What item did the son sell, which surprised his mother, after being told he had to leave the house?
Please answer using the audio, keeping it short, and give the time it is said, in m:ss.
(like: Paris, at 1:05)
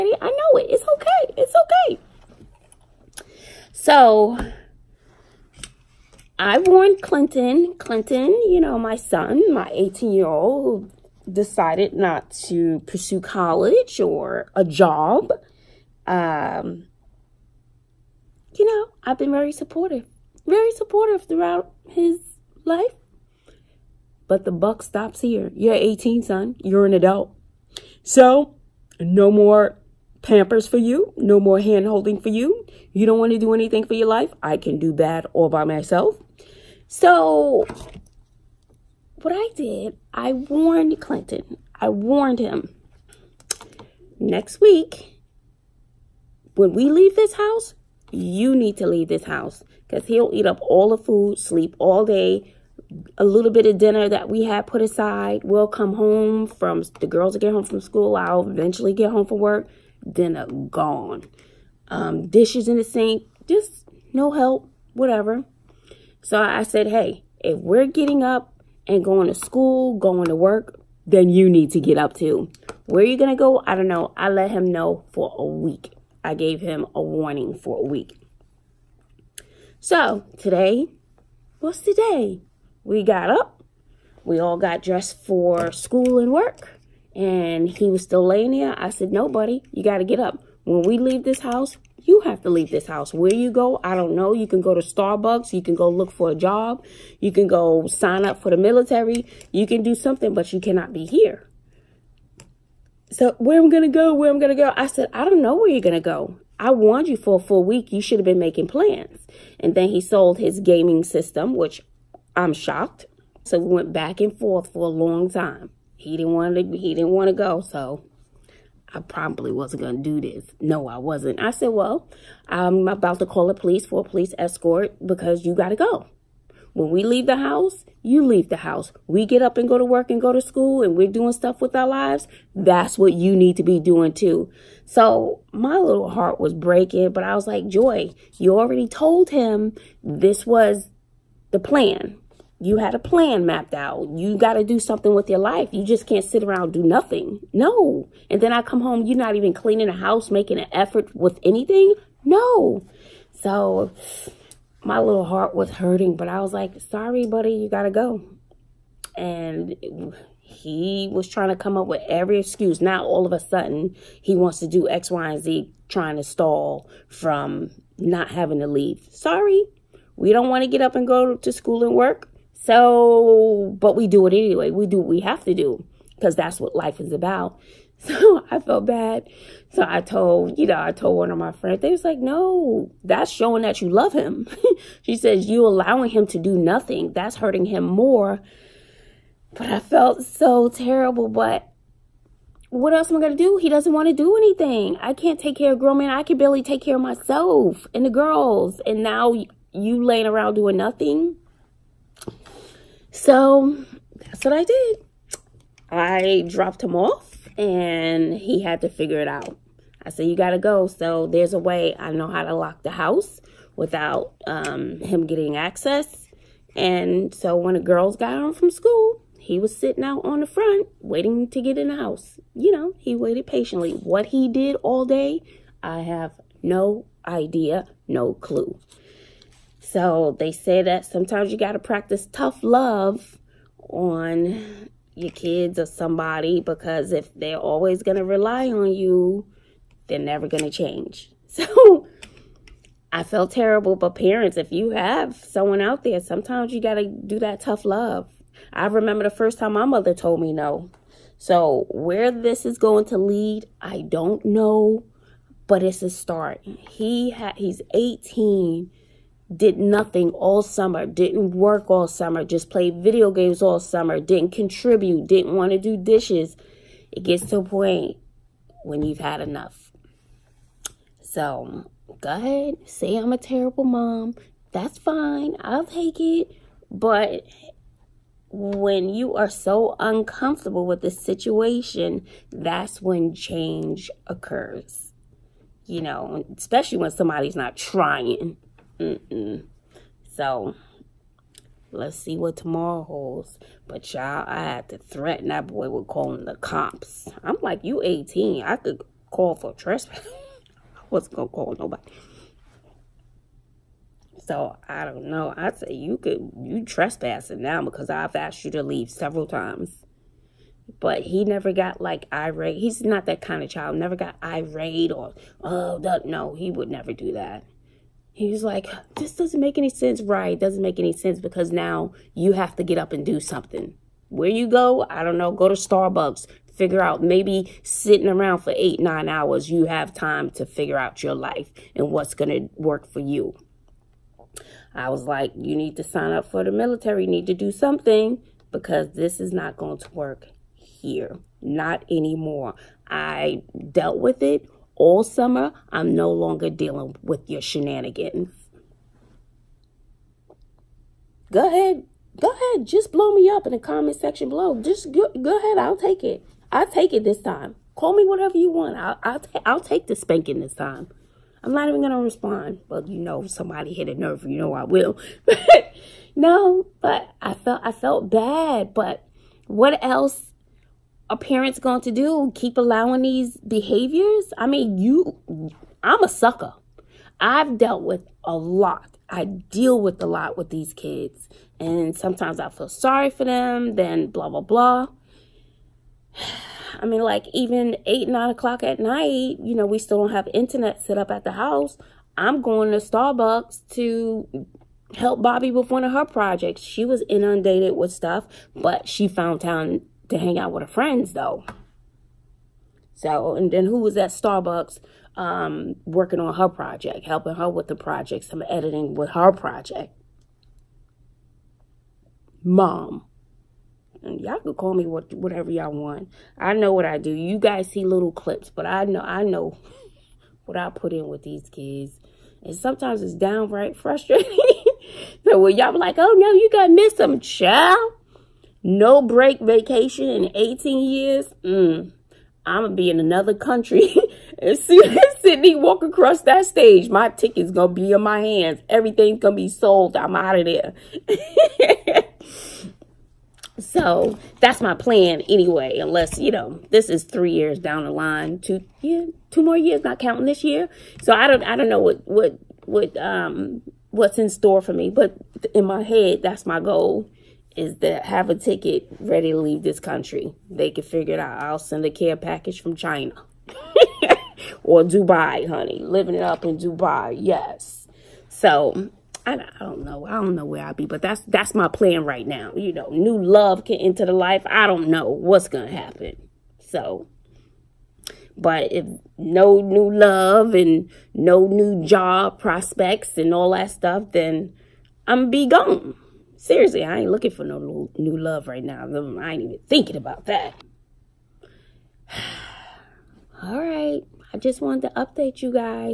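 His gaming system, at 1:50.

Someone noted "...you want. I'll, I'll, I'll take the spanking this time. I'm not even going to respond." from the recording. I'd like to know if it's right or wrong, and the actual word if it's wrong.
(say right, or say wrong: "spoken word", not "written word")
right.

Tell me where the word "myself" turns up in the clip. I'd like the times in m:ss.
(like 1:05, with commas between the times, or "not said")
0:35, 3:17.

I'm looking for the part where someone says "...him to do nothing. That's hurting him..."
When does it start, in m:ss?
3:06.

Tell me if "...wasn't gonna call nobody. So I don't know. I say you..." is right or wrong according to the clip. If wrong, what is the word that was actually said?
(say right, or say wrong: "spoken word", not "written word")
right.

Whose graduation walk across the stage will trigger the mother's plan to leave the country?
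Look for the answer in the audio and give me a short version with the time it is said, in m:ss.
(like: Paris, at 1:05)
Sydney, at 7:15.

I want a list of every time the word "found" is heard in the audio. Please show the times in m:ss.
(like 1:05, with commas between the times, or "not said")
6:39.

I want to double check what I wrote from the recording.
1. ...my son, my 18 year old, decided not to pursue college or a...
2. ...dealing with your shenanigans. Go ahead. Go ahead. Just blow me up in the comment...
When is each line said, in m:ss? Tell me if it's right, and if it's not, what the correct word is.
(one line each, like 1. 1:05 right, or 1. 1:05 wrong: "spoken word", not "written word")
1. 0:08 right
2. 5:46 right.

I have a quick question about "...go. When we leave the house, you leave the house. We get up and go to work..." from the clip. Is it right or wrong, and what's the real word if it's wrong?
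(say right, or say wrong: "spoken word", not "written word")
right.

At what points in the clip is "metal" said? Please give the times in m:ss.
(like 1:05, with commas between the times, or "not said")
not said.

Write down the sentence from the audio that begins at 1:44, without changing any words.
I said, I don't know where you're going to go.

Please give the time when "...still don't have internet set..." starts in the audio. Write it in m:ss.
6:29.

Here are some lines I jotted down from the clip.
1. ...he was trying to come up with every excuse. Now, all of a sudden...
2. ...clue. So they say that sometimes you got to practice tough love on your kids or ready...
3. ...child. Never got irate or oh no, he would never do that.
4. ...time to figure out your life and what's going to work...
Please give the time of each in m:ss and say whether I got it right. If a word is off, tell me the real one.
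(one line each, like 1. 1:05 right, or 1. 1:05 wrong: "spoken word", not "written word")
1. 2:40 right
2. 3:48 wrong: "somebody", not "ready"
3. 5:13 right
4. 5:30 right.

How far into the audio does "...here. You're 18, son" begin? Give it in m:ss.
0:25.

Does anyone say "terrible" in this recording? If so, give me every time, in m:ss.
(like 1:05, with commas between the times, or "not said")
3:10, 4:03, 4:33.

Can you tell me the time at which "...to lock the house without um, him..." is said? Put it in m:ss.
3:32.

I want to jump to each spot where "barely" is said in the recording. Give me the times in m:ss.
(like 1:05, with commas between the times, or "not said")
3:16.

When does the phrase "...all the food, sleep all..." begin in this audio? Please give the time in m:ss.
0:50.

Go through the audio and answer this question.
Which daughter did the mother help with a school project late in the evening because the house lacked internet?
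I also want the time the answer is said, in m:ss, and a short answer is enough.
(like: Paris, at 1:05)
Bobby, at 6:35.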